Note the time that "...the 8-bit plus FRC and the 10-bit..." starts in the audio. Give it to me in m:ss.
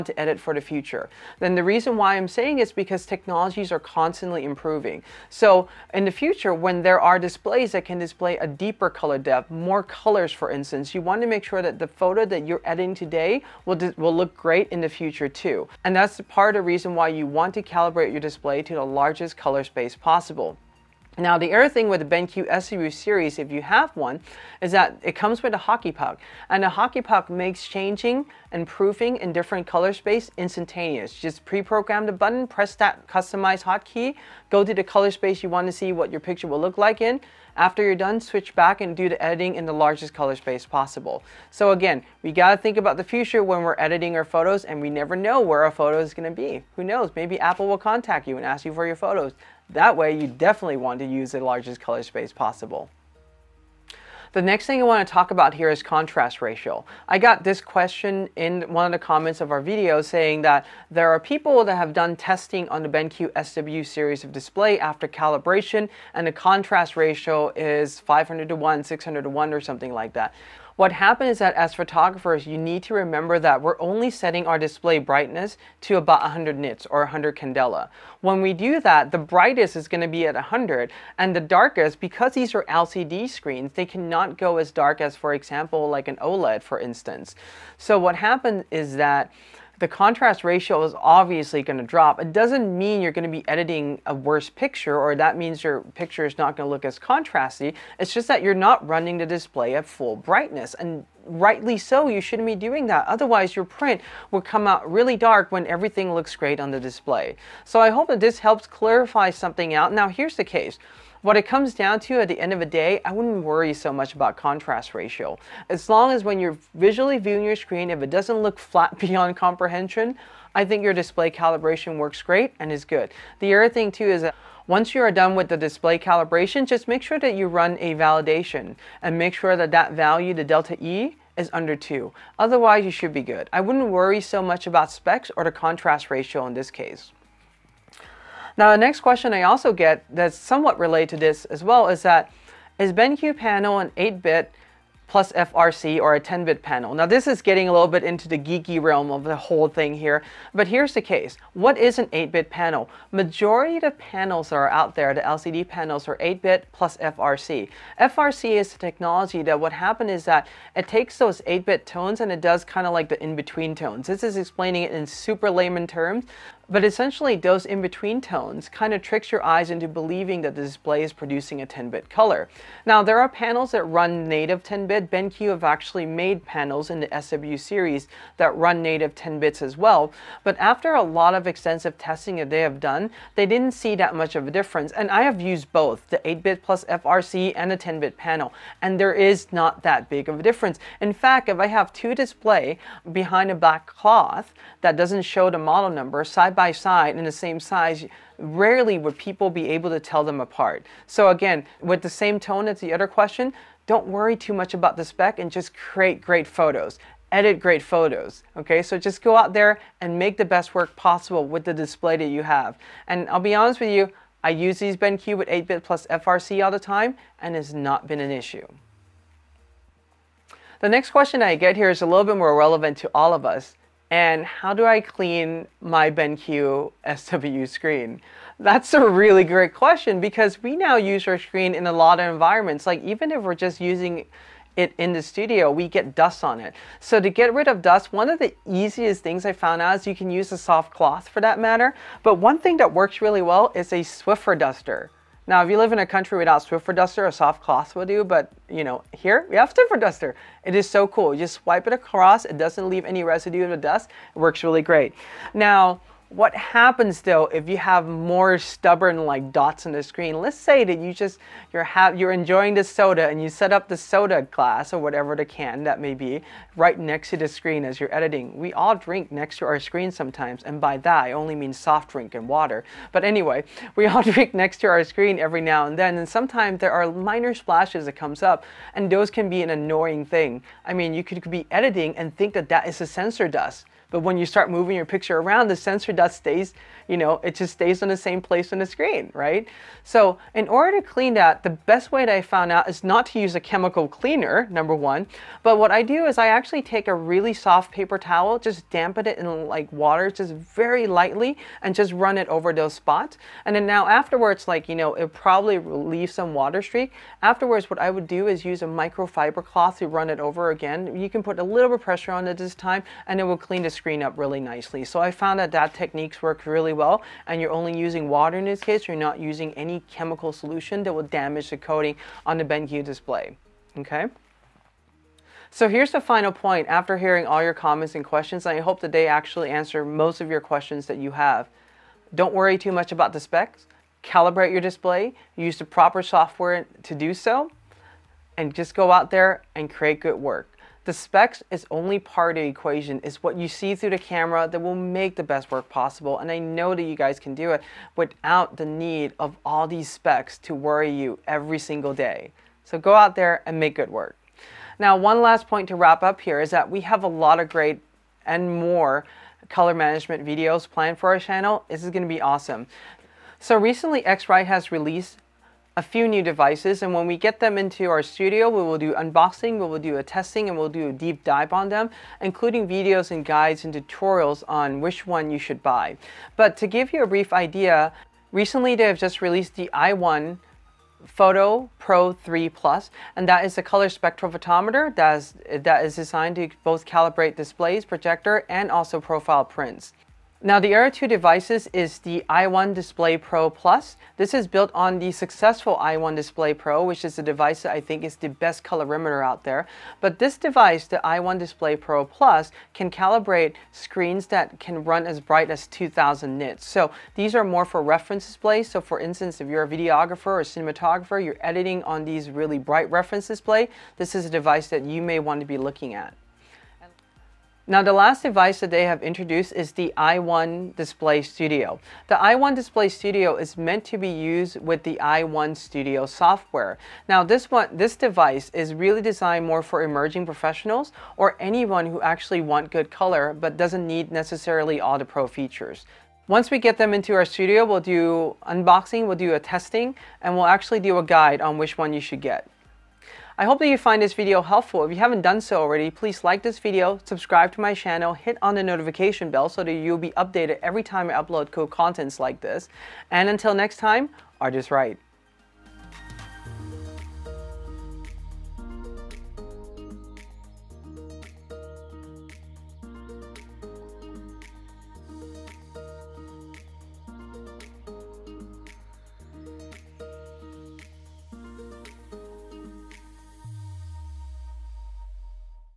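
3:06.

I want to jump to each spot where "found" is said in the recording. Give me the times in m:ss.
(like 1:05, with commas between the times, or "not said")
3:59, 4:52, 5:15.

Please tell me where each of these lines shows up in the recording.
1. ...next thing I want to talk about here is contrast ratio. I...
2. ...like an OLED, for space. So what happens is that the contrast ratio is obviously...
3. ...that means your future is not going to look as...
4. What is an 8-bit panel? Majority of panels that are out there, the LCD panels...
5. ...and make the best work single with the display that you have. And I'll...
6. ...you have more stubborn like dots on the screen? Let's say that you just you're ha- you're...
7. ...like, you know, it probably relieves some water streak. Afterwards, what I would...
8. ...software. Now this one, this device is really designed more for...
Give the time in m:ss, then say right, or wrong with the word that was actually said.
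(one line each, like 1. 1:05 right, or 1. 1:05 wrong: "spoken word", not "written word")
1. 0:54 right
2. 1:25 wrong: "instance", not "space"
3. 1:35 wrong: "picture", not "future"
4. 2:31 right
5. 3:29 wrong: "possible", not "single"
6. 4:17 right
7. 5:04 right
8. 7:06 right.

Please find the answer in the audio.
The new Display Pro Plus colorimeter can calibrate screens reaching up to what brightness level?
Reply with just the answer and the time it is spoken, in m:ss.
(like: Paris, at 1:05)
2000 nits, at 6:45.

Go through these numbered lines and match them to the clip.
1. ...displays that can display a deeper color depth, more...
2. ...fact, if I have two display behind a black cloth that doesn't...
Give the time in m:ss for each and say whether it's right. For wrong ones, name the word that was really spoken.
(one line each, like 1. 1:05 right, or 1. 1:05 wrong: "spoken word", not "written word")
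1. 0:07 right
2. 3:11 right.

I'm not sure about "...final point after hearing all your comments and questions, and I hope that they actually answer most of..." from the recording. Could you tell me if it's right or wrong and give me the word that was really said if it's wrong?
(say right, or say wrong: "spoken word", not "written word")
right.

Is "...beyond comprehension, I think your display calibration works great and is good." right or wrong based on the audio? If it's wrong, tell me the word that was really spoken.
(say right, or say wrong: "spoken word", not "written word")
right.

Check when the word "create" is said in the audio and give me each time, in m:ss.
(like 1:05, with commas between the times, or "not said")
3:25, 5:39.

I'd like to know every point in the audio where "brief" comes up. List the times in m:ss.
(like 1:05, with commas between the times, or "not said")
6:17.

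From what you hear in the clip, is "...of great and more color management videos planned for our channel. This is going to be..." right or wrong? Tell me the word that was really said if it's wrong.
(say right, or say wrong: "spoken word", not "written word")
right.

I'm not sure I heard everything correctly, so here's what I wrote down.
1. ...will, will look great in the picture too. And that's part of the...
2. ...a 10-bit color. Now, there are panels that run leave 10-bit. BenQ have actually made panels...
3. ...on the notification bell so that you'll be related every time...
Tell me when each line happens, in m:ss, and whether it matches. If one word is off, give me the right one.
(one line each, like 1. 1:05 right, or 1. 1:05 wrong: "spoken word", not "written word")
1. 0:13 wrong: "future", not "picture"
2. 2:51 wrong: "native", not "leave"
3. 7:28 wrong: "updated", not "related".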